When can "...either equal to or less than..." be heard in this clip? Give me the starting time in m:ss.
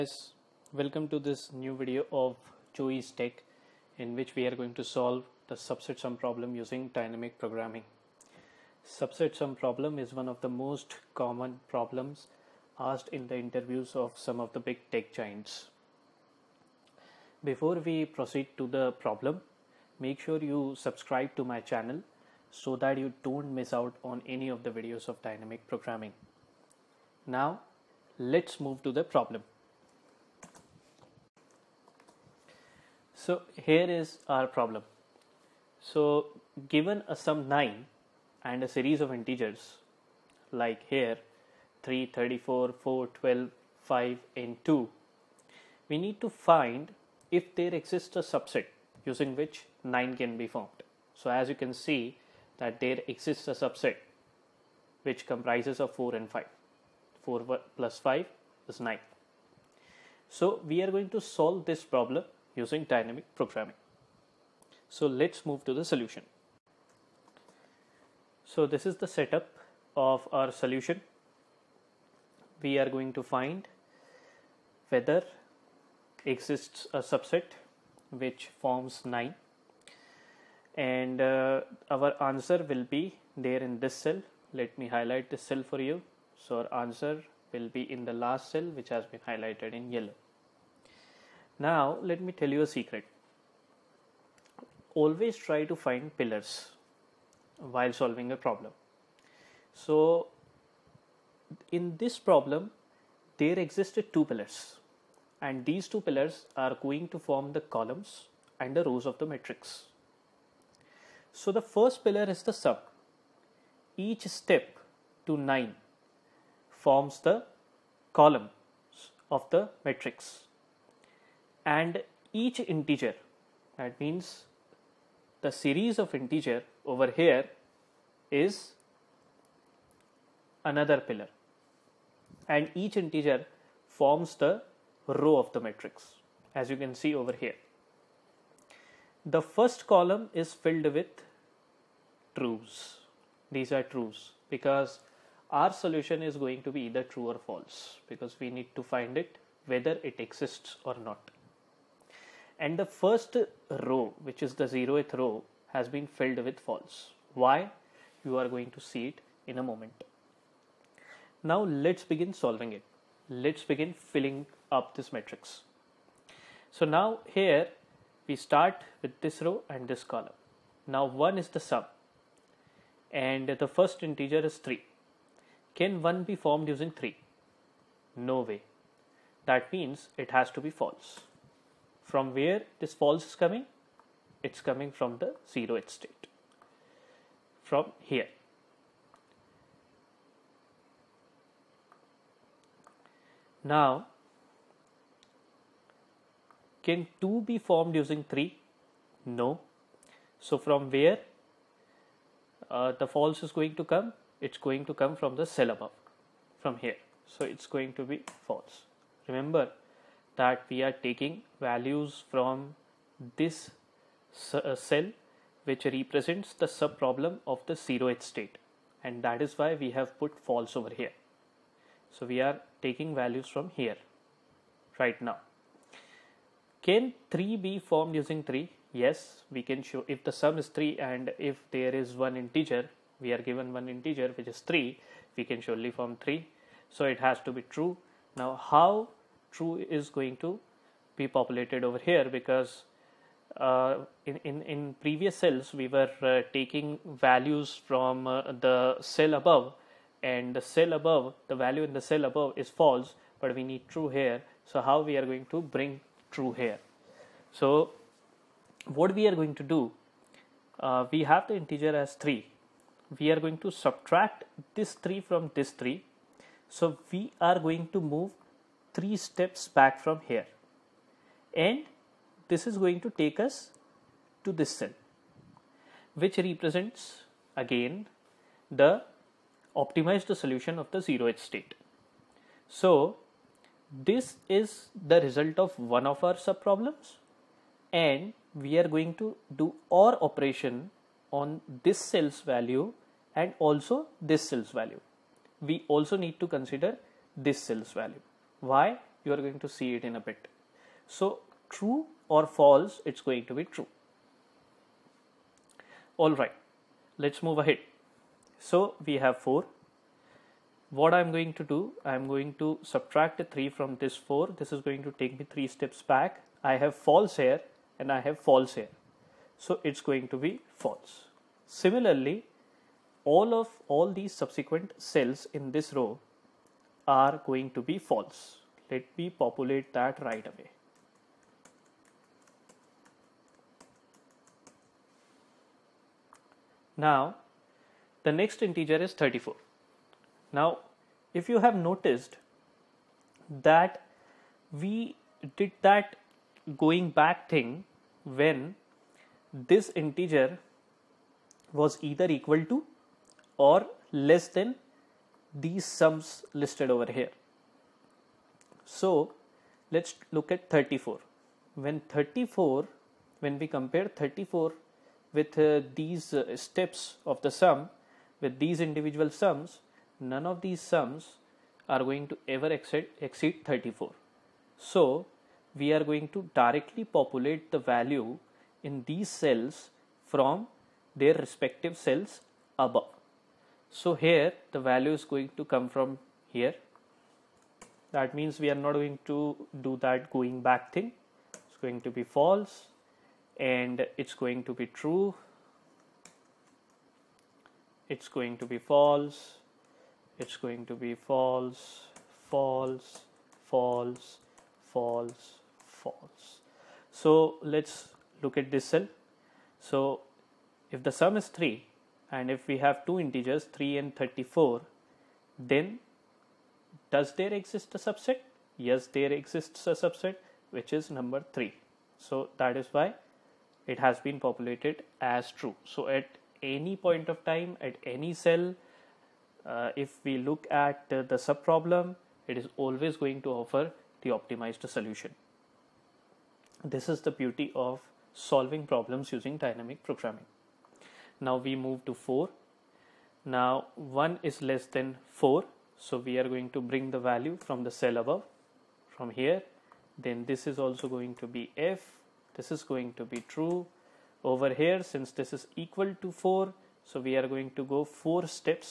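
5:52.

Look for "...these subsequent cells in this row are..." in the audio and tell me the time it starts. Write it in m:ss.
5:24.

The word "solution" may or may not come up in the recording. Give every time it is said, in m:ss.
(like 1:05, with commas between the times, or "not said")
1:05, 1:10, 2:25, 4:40, 7:14.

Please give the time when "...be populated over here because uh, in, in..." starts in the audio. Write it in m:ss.
4:01.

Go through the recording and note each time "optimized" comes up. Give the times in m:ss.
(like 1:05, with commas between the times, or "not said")
4:39, 7:14.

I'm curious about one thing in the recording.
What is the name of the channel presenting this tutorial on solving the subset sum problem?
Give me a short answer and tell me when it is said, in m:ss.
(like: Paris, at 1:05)
Joey's Tech, at 0:02.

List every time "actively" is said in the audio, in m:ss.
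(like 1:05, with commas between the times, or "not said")
not said.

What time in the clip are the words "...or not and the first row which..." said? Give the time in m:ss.
2:30.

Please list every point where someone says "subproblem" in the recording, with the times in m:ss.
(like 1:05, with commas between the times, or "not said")
3:36, 4:46, 7:11.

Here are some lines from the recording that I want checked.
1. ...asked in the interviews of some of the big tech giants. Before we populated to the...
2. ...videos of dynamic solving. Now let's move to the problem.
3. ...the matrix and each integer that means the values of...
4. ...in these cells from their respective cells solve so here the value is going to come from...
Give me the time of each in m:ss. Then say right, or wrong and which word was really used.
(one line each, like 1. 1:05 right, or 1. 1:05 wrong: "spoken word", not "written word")
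1. 0:12 wrong: "proceed", not "populated"
2. 0:24 wrong: "programming", not "solving"
3. 1:59 wrong: "series", not "values"
4. 6:18 wrong: "above", not "solve".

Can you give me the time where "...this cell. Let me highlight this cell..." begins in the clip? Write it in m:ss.
1:23.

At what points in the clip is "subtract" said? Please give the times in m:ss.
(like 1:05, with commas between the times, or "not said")
4:23, 5:12.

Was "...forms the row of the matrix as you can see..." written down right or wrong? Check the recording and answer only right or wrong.
right.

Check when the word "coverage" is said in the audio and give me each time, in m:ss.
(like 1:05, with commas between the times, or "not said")
not said.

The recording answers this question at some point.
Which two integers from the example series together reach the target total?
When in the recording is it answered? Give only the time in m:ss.
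0:55.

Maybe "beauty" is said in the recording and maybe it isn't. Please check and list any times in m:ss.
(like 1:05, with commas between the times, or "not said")
7:17.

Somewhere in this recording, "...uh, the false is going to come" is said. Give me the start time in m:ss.
3:22.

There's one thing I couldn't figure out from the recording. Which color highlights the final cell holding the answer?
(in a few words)
yellow.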